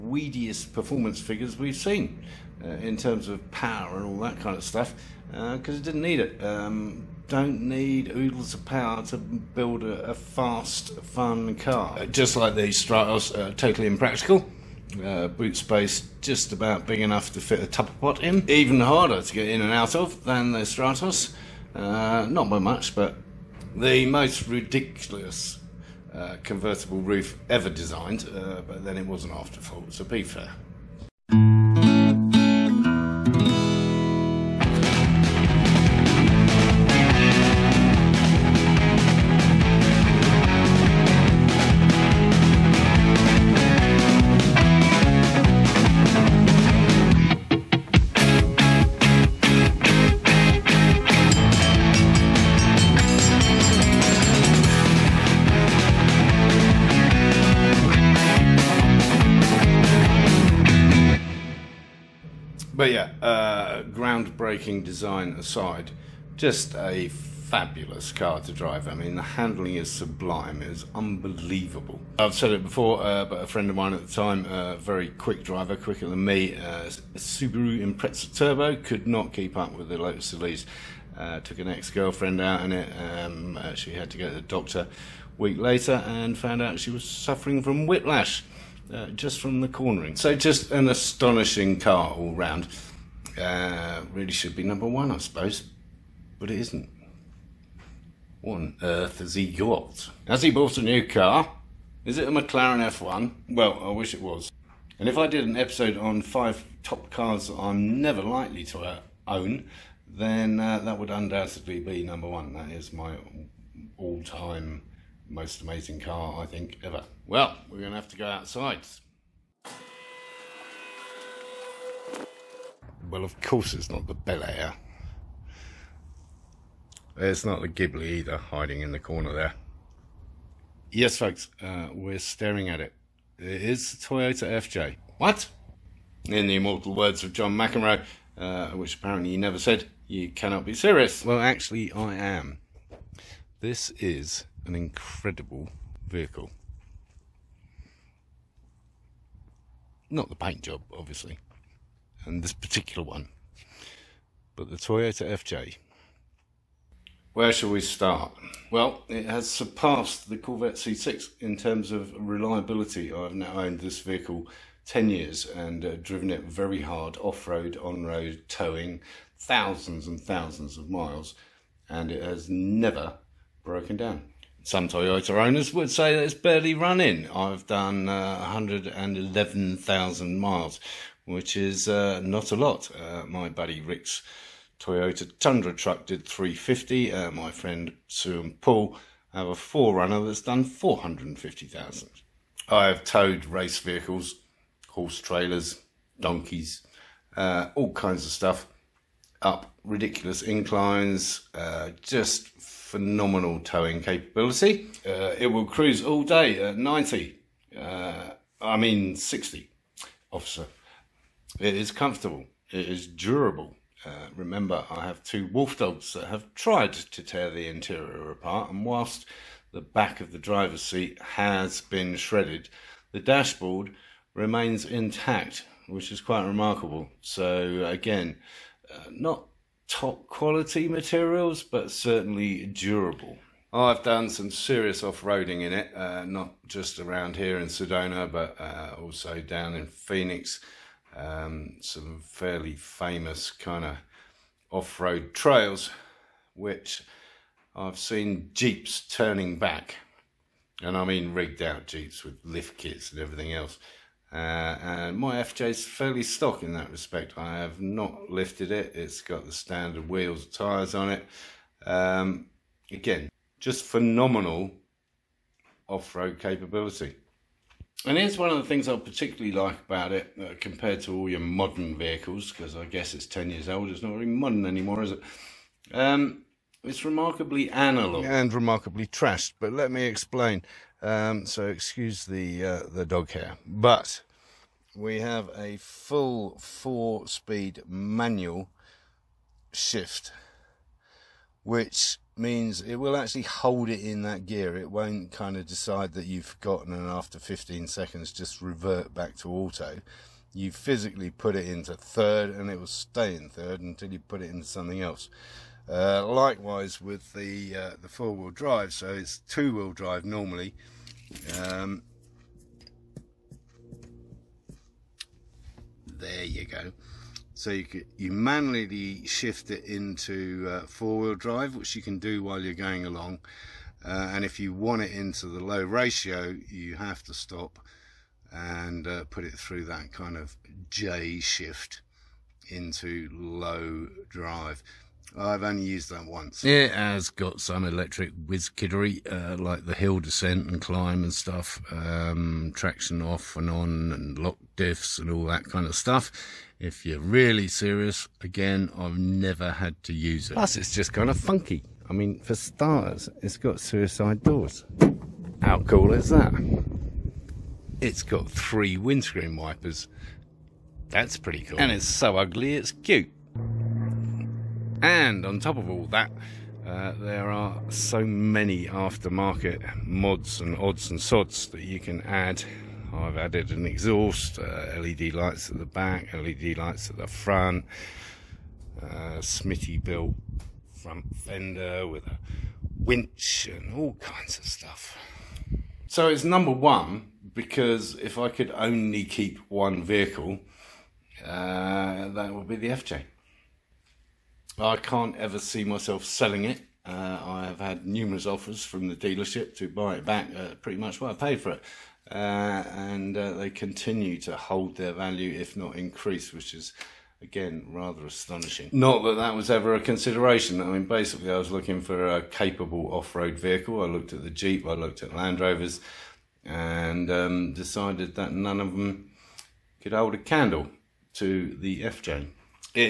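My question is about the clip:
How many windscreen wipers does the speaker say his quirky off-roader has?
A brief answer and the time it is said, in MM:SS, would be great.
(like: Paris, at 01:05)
3, at 05:58.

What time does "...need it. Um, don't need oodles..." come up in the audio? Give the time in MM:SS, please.
00:06.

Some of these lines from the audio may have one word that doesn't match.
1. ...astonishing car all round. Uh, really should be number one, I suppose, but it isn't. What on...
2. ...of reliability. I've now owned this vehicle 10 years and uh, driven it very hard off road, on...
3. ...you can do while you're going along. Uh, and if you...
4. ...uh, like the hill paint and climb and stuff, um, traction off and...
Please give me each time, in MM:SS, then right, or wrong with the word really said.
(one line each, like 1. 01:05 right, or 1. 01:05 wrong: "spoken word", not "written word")
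1. 01:30 right
2. 02:41 right
3. 05:21 right
4. 05:39 wrong: "descent", not "paint".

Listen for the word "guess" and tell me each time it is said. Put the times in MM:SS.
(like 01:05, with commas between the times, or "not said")
04:32.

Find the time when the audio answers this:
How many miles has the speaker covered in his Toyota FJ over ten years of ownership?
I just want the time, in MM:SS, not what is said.
02:58.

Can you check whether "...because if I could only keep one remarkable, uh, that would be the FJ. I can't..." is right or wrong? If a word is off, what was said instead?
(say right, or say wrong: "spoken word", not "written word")
wrong: "vehicle", not "remarkable".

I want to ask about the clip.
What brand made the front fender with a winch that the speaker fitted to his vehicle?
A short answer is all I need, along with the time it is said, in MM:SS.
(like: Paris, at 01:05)
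Smittybilt, at 06:19.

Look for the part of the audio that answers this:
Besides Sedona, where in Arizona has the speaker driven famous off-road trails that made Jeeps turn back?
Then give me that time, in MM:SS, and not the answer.
03:59.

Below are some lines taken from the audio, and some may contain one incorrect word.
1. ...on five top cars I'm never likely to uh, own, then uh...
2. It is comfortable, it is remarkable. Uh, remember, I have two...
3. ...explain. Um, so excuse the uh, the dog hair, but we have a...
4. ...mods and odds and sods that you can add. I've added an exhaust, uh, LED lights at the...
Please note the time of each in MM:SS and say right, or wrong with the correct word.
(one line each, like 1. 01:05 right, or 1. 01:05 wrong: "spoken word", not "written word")
1. 01:45 right
2. 03:31 wrong: "durable", not "remarkable"
3. 04:40 right
4. 06:10 right.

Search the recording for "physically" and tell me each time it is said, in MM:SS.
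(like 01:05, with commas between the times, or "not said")
05:00.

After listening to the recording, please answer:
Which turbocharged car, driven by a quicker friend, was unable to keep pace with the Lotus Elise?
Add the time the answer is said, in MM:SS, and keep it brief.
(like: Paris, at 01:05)
Subaru Impreza Turbo, at 01:17.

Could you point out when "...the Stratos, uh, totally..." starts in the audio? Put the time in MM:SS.
00:12.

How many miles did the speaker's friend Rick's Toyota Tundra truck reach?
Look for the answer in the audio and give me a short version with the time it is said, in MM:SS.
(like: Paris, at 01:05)
350, at 03:06.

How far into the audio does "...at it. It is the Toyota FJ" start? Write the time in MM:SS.
02:12.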